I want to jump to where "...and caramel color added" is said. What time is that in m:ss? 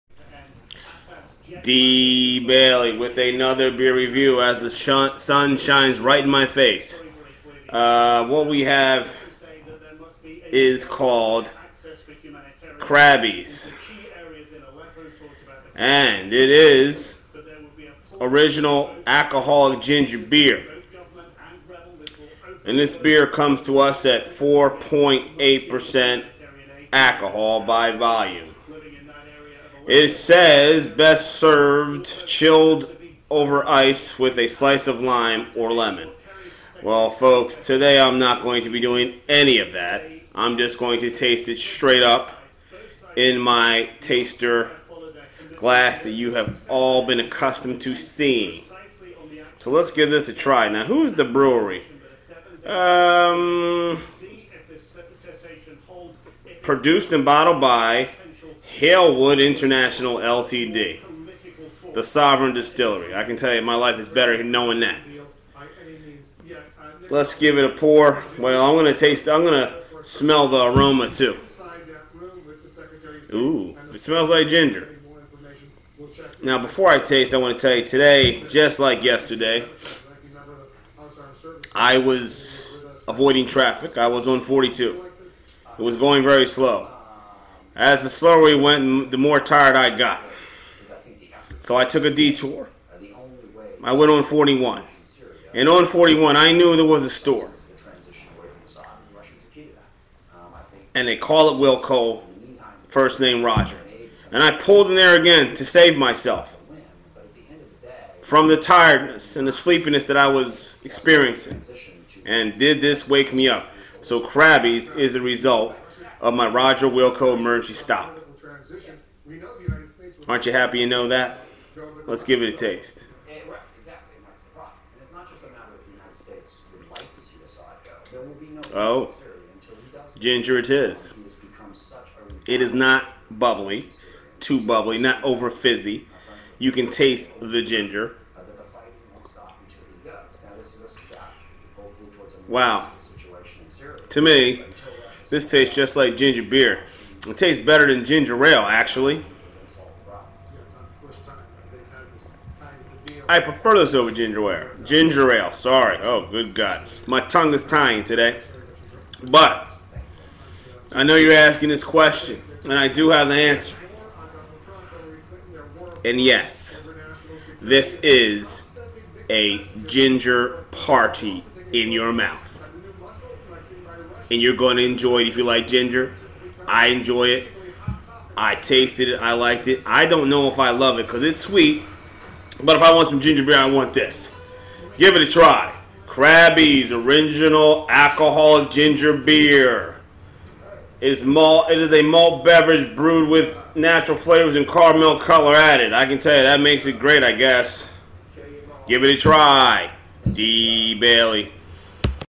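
3:14.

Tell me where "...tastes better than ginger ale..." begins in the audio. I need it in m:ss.
2:27.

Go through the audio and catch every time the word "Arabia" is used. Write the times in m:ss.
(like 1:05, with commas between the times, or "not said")
not said.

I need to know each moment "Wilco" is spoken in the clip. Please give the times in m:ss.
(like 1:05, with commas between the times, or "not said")
1:41, 1:56.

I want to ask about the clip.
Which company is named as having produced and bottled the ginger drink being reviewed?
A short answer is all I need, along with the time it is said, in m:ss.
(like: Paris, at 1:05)
Halewood International LTD, at 0:58.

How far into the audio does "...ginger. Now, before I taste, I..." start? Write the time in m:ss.
1:14.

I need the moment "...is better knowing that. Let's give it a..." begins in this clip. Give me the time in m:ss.
1:03.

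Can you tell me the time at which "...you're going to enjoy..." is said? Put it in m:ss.
2:54.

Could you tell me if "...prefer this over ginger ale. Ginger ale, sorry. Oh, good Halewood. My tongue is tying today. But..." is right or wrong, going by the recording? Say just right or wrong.
wrong.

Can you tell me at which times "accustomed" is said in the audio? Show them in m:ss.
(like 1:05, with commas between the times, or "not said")
0:47.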